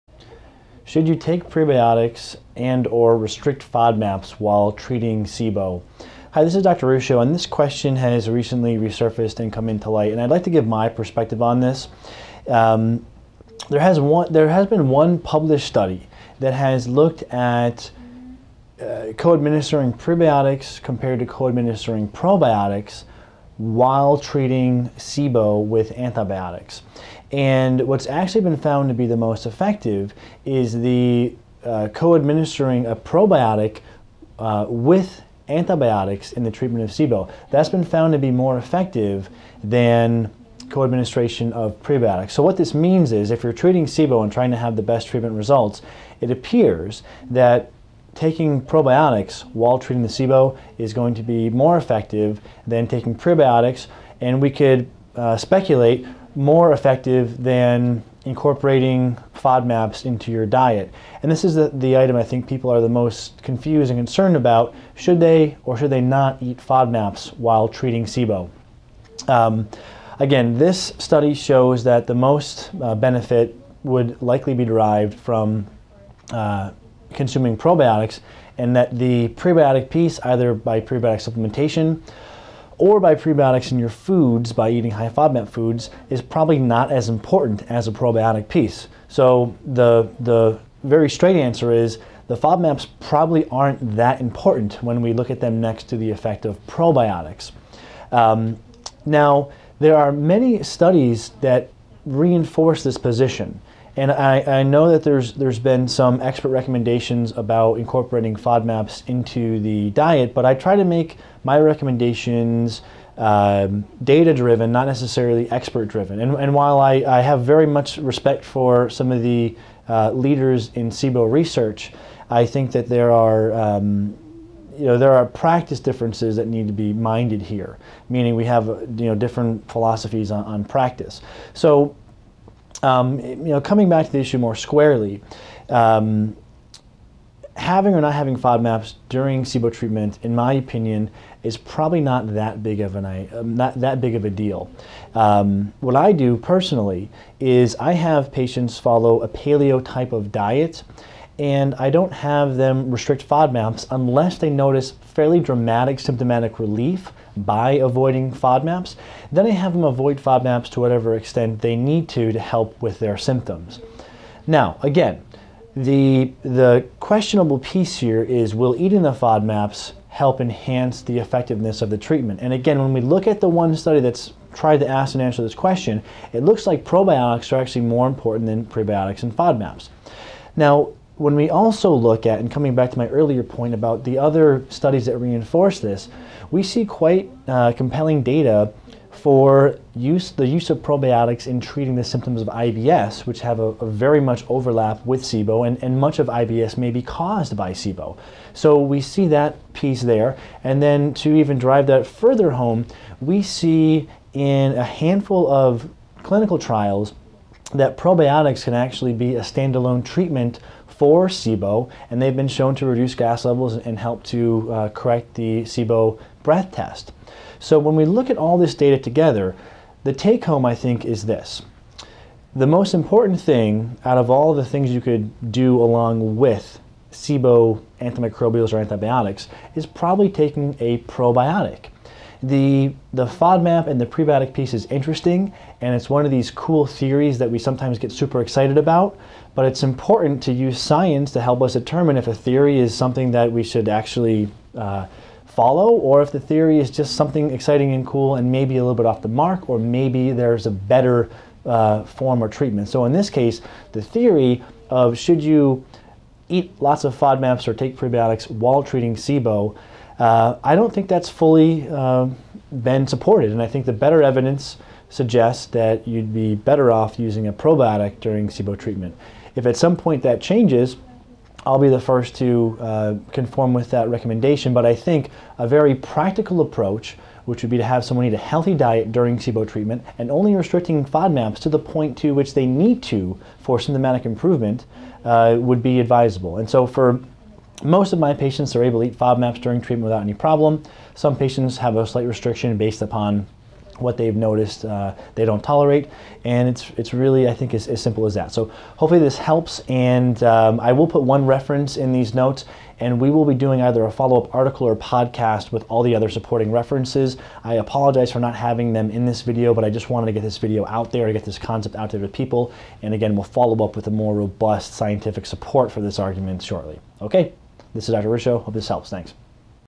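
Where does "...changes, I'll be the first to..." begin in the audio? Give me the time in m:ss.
4:30.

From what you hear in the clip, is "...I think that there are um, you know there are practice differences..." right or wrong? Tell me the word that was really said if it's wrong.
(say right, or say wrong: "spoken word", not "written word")
right.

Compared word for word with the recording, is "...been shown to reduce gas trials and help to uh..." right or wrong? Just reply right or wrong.
wrong.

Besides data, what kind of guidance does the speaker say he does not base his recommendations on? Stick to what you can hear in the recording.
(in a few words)
expert driven.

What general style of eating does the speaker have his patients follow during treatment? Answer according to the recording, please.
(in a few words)
paleo.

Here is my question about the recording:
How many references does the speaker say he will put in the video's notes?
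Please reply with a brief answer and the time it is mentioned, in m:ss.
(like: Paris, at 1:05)
1, at 5:01.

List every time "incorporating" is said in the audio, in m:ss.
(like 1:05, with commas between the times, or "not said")
0:58, 1:47.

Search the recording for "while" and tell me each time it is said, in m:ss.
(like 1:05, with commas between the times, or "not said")
0:04, 0:23, 0:49, 1:07, 1:56, 4:18.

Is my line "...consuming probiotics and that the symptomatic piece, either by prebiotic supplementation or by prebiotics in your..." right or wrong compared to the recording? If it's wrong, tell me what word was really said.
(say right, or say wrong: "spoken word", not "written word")
wrong: "prebiotic", not "symptomatic".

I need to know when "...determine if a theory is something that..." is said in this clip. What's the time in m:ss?
4:01.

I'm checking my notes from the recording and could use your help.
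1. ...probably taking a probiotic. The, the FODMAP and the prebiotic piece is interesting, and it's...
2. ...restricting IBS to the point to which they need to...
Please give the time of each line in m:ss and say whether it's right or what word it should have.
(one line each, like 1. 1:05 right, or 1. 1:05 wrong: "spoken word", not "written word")
1. 3:49 right
2. 4:40 wrong: "FODMAPs", not "IBS".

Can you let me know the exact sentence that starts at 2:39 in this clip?
Then I have them avoid FODMAPs to whatever extent they need to to help with their symptoms.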